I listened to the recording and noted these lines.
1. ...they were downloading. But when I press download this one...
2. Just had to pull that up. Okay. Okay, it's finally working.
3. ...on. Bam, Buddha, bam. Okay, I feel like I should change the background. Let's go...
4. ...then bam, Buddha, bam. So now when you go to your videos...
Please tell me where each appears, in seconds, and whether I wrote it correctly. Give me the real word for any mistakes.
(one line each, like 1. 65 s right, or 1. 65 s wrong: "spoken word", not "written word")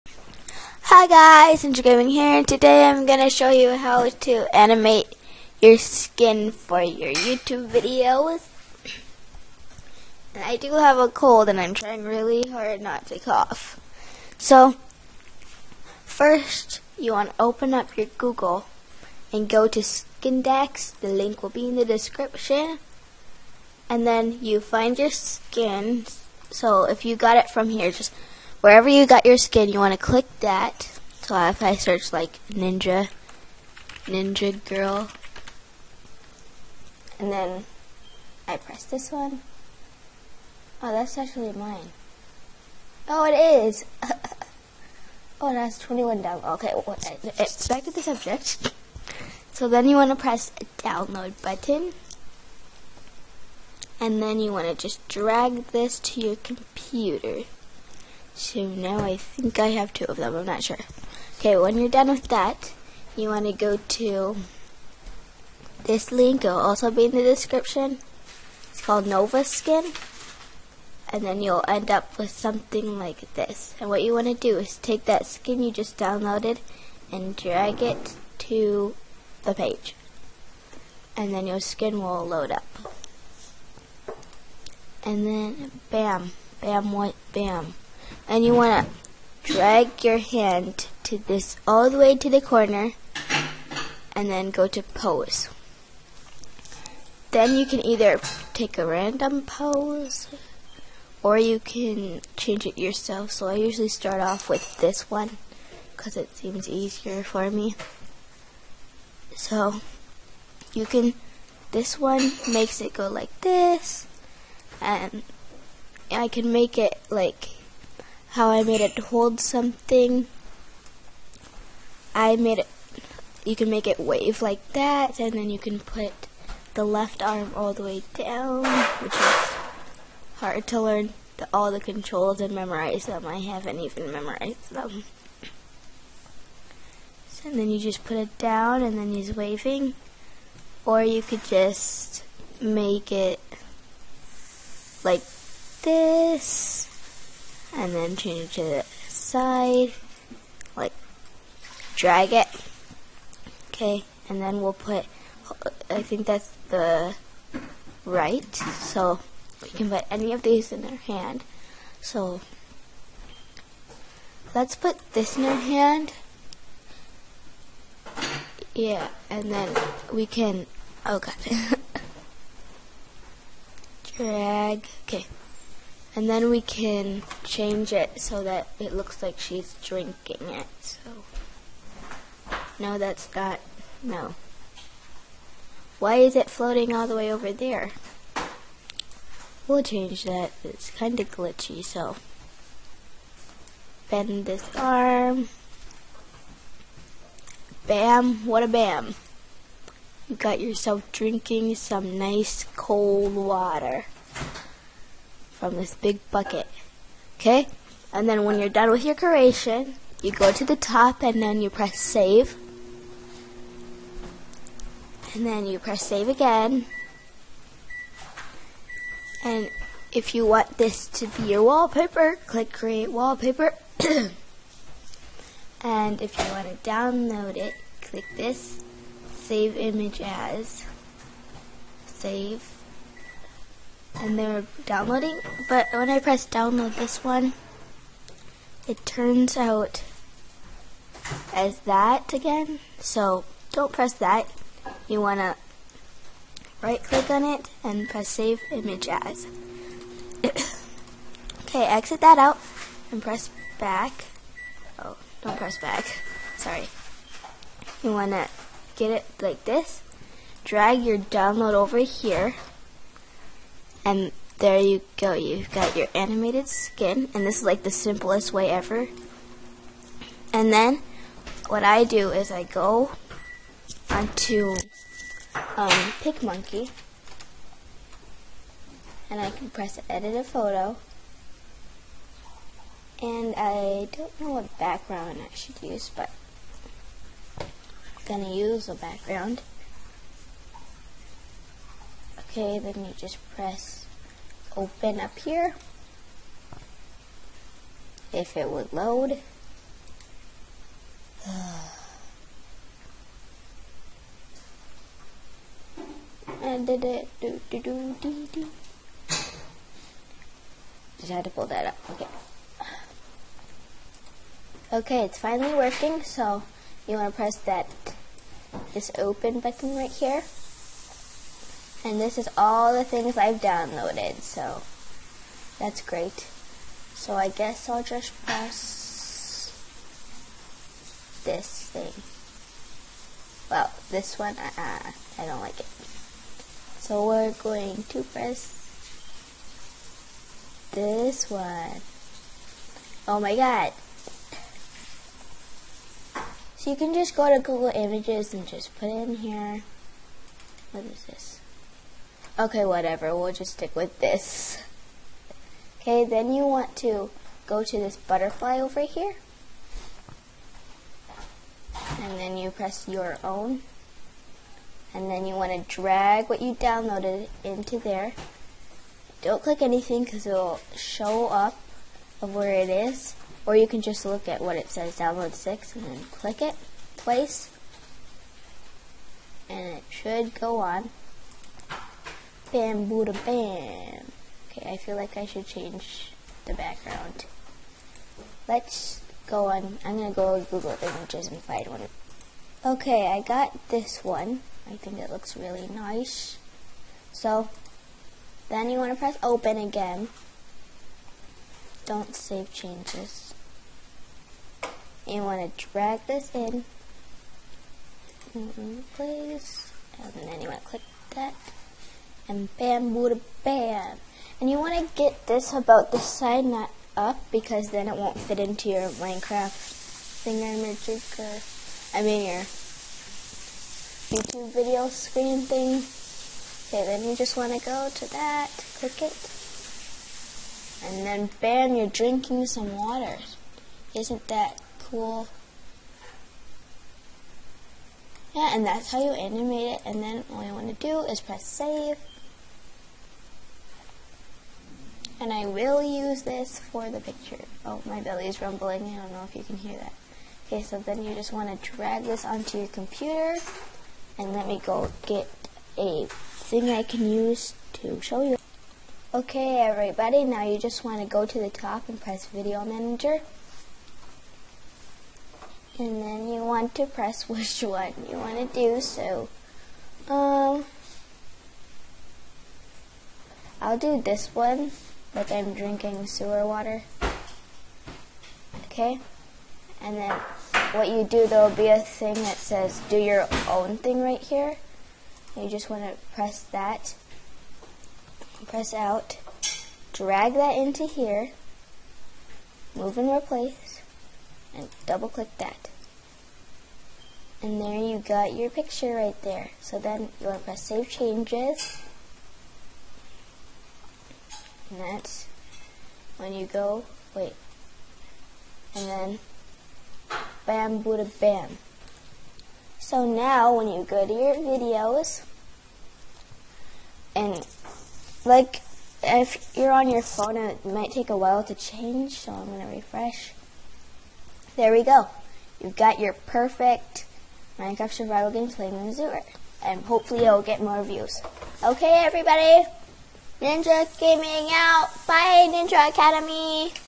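1. 234 s right
2. 311 s right
3. 380 s right
4. 509 s right.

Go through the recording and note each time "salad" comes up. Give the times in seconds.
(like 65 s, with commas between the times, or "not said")
not said.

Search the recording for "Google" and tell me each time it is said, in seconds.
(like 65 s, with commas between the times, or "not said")
18 s, 347 s, 390 s.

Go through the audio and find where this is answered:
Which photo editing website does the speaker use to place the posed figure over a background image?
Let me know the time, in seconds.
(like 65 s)
276 s.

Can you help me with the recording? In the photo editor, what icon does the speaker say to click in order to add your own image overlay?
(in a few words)
butterfly.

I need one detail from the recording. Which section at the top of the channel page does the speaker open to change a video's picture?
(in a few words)
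Video Manager.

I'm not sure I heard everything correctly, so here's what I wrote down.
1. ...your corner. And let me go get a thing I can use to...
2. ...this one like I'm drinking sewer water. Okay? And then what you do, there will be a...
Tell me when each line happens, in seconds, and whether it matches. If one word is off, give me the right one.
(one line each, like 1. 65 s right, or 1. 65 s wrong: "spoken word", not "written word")
1. 452 s wrong: "computer", not "corner"
2. 474 s right.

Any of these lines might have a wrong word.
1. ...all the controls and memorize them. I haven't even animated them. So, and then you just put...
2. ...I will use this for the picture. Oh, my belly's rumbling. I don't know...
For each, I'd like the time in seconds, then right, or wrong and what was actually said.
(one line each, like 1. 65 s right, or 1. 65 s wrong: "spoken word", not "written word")
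1. 131 s wrong: "memorized", not "animated"
2. 445 s right.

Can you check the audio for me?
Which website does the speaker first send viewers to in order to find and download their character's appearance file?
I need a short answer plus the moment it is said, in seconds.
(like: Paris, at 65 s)
Skindex, at 19 s.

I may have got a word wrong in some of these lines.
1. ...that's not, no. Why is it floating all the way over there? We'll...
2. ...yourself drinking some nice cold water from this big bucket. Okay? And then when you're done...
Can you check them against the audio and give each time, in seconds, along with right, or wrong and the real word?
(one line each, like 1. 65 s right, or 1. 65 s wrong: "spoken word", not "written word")
1. 182 s right
2. 200 s right.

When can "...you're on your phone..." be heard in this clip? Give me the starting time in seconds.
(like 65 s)
519 s.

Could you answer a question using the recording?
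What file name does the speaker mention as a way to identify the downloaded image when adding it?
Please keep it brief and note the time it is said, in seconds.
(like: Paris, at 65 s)
download 6, at 375 s.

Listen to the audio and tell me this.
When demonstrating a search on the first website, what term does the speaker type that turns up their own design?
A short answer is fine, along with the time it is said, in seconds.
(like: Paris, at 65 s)
ninja girl, at 34 s.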